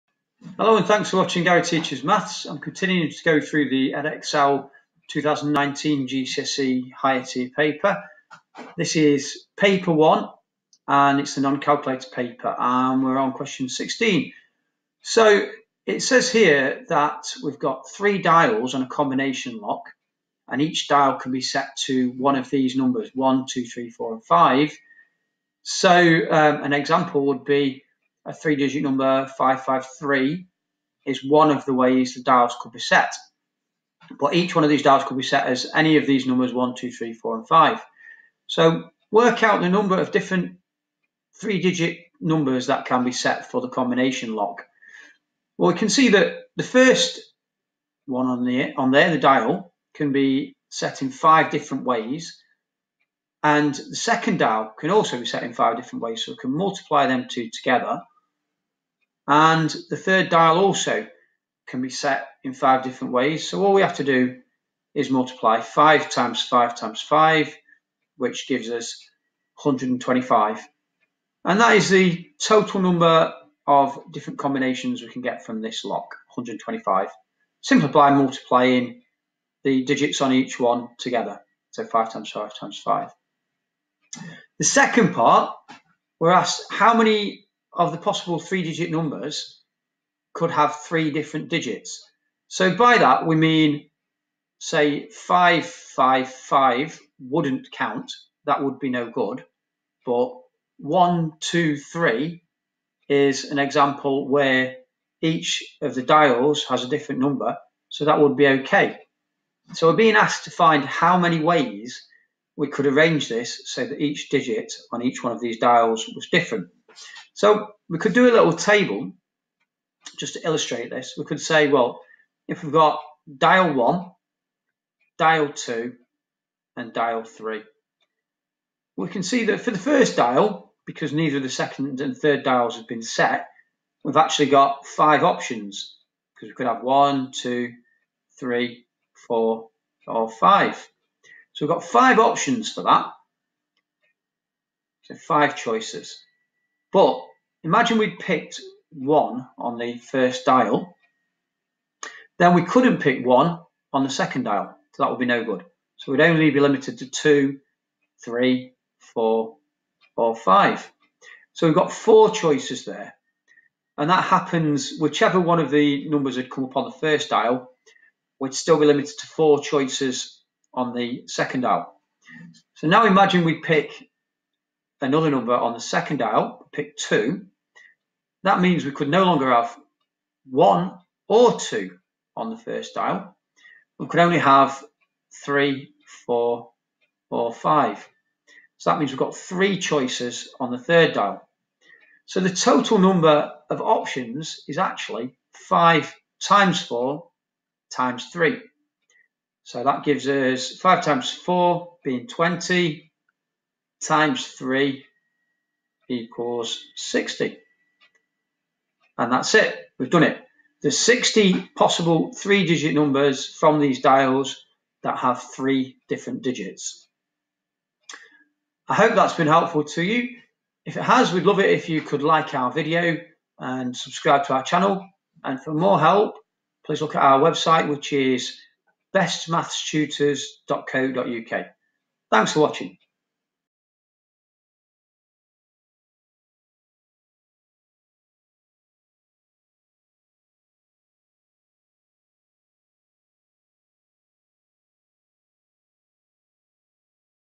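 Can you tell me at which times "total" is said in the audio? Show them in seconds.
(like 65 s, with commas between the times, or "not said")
72 s, 192 s.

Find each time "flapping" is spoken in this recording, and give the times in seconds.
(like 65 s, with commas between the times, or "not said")
not said.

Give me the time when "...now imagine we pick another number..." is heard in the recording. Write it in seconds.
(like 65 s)
172 s.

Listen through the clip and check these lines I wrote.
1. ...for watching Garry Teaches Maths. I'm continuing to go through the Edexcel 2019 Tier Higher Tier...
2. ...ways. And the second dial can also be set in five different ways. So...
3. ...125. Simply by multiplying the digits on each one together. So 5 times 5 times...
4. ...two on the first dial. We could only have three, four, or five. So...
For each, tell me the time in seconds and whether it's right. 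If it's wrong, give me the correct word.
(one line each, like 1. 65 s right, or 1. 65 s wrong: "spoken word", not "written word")
1. 1 s wrong: "GCSE", not "Tier"
2. 51 s right
3. 76 s right
4. 181 s right.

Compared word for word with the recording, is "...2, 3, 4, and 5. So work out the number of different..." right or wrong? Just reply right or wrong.
right.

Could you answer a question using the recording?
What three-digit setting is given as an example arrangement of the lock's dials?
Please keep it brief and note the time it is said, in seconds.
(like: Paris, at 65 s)
553, at 29 s.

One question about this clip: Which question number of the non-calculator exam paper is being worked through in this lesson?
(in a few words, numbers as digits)
16.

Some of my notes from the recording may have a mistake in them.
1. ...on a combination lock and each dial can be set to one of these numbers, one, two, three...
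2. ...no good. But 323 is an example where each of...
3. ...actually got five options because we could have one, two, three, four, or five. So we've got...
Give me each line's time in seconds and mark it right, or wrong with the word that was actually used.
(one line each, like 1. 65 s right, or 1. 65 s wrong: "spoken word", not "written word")
1. 18 s right
2. 98 s wrong: "123", not "323"
3. 134 s right.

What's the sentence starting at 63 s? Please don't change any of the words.
So all we have to do is multiply 5 times 5 times 5, which gives us 125.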